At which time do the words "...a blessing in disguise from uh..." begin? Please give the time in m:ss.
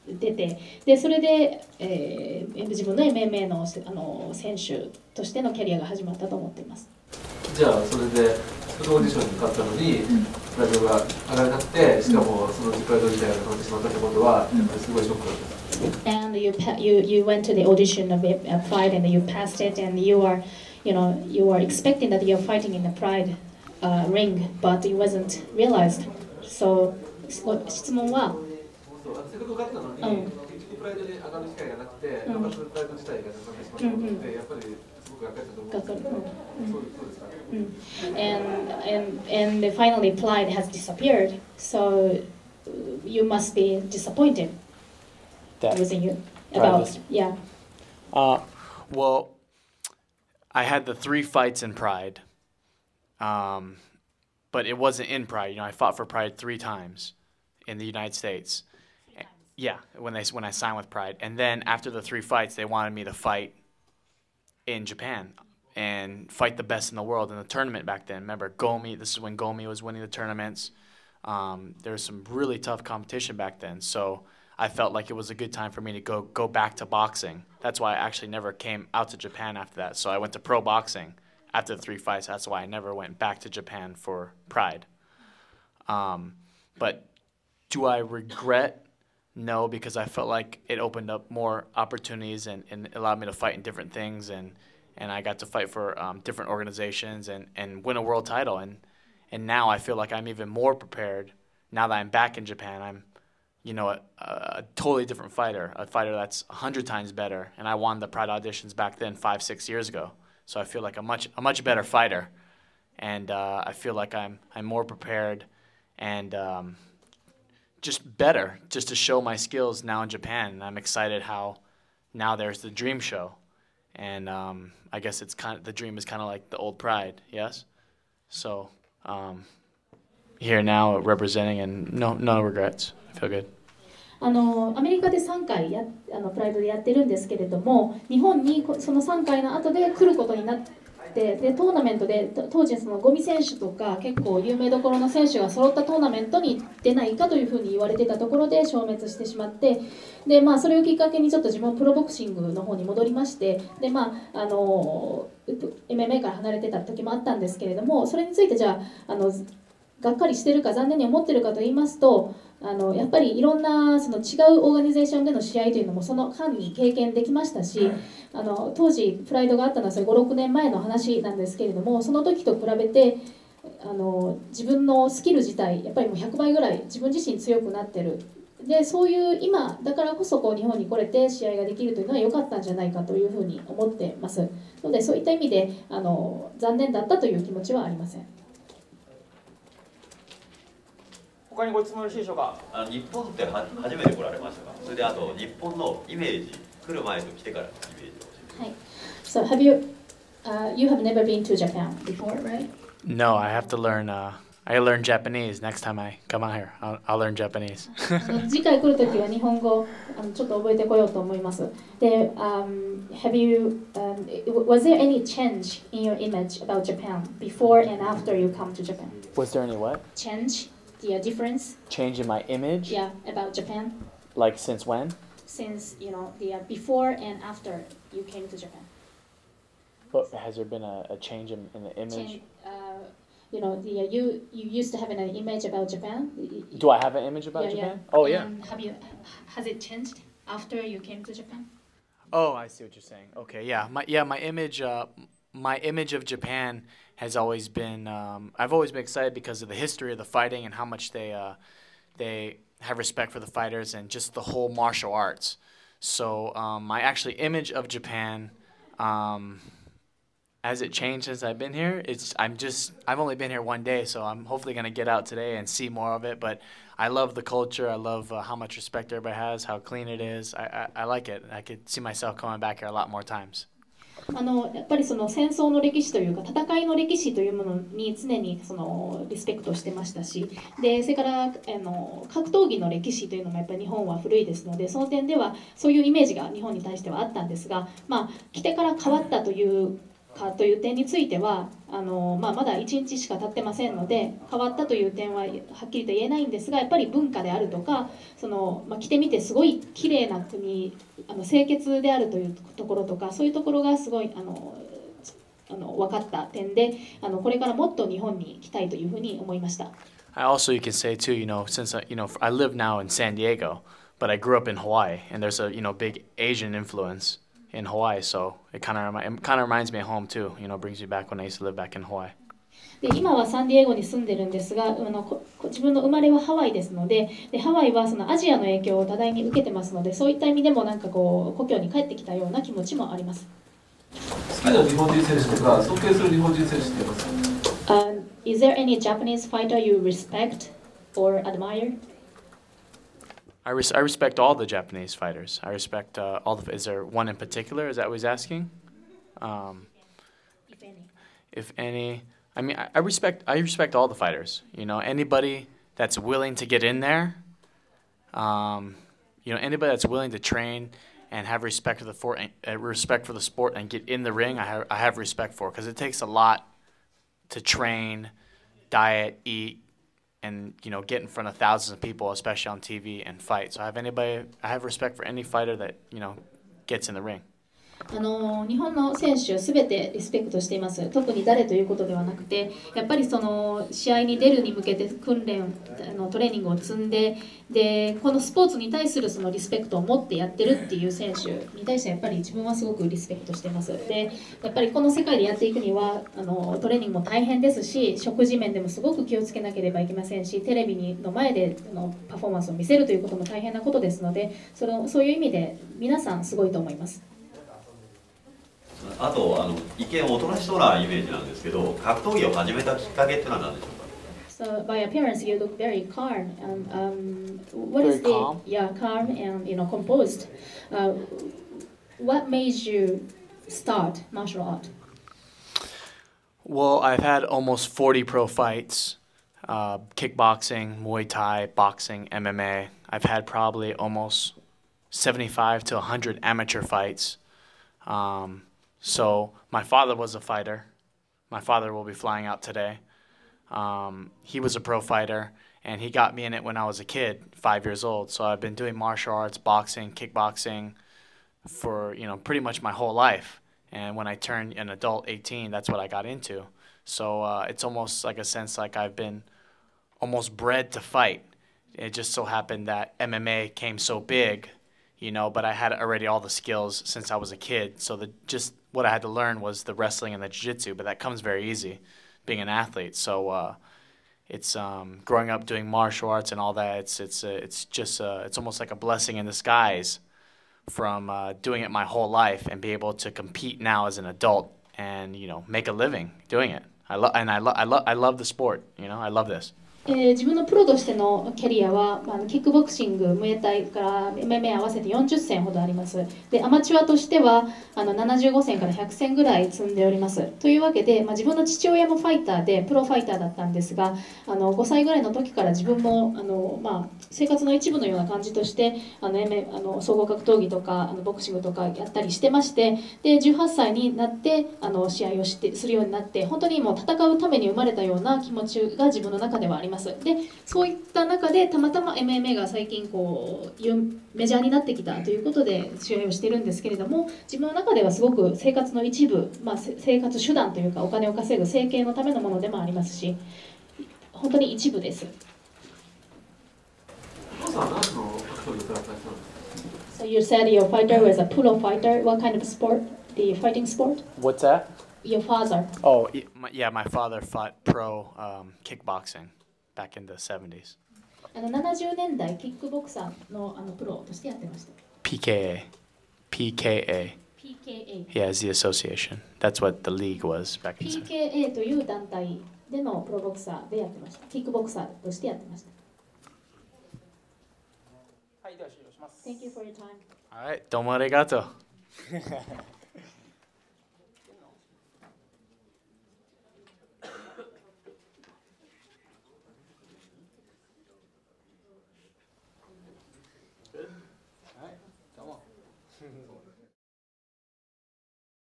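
7:58.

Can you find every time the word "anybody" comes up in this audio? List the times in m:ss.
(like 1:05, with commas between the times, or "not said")
5:54, 5:59, 6:13.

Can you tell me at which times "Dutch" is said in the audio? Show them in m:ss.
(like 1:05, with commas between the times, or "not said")
not said.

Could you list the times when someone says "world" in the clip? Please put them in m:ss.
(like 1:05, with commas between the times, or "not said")
1:07, 1:38.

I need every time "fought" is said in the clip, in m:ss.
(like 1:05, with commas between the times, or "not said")
0:55, 9:07.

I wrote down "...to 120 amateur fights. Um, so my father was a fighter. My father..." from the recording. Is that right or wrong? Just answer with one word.
wrong.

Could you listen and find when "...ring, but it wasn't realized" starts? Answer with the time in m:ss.
0:24.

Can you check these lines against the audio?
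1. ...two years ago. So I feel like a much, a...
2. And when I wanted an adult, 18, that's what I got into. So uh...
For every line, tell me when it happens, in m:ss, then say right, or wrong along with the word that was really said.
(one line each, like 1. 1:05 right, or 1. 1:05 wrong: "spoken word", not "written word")
1. 1:49 wrong: "six", not "two"
2. 7:33 wrong: "turned", not "wanted".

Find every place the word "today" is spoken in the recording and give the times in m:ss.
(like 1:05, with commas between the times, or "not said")
4:25, 7:22.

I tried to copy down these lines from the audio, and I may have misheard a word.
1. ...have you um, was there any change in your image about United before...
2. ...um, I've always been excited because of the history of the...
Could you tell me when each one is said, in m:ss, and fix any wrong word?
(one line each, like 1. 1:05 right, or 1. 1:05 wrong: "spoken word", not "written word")
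1. 3:33 wrong: "Japan", not "United"
2. 4:08 right.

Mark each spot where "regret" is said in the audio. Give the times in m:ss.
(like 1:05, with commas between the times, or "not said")
1:27, 2:12.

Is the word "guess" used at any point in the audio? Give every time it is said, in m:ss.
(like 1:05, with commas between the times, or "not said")
2:04.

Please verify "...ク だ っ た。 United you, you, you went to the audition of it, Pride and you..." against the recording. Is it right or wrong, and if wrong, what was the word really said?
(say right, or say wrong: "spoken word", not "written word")
wrong: "And", not "United".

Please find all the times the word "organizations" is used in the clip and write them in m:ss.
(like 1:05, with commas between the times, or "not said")
1:36.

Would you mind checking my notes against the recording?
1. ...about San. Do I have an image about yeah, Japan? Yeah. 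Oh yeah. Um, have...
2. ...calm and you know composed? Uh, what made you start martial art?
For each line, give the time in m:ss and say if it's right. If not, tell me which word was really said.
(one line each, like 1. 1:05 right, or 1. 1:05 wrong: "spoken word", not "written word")
1. 3:55 wrong: "Japan", not "San"
2. 6:58 right.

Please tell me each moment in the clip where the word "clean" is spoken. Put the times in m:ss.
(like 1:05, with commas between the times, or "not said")
4:29.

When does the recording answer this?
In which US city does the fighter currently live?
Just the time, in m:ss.
5:13.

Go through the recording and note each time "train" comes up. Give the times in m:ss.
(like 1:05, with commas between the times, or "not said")
6:00, 6:07.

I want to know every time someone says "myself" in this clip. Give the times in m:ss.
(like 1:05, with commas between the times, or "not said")
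4:31.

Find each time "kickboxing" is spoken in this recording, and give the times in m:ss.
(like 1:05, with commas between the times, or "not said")
7:10, 7:30, 9:08.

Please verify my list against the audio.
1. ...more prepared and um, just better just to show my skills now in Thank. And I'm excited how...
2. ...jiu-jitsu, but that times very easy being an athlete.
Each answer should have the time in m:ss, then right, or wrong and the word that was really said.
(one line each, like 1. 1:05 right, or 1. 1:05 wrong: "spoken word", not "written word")
1. 1:54 wrong: "Japan", not "Thank"
2. 7:50 wrong: "comes", not "times".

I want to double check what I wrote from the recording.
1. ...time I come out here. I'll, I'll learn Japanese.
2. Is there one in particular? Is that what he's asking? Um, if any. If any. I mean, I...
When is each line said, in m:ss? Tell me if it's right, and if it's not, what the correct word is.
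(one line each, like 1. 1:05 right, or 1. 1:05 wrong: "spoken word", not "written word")
1. 3:25 right
2. 5:46 right.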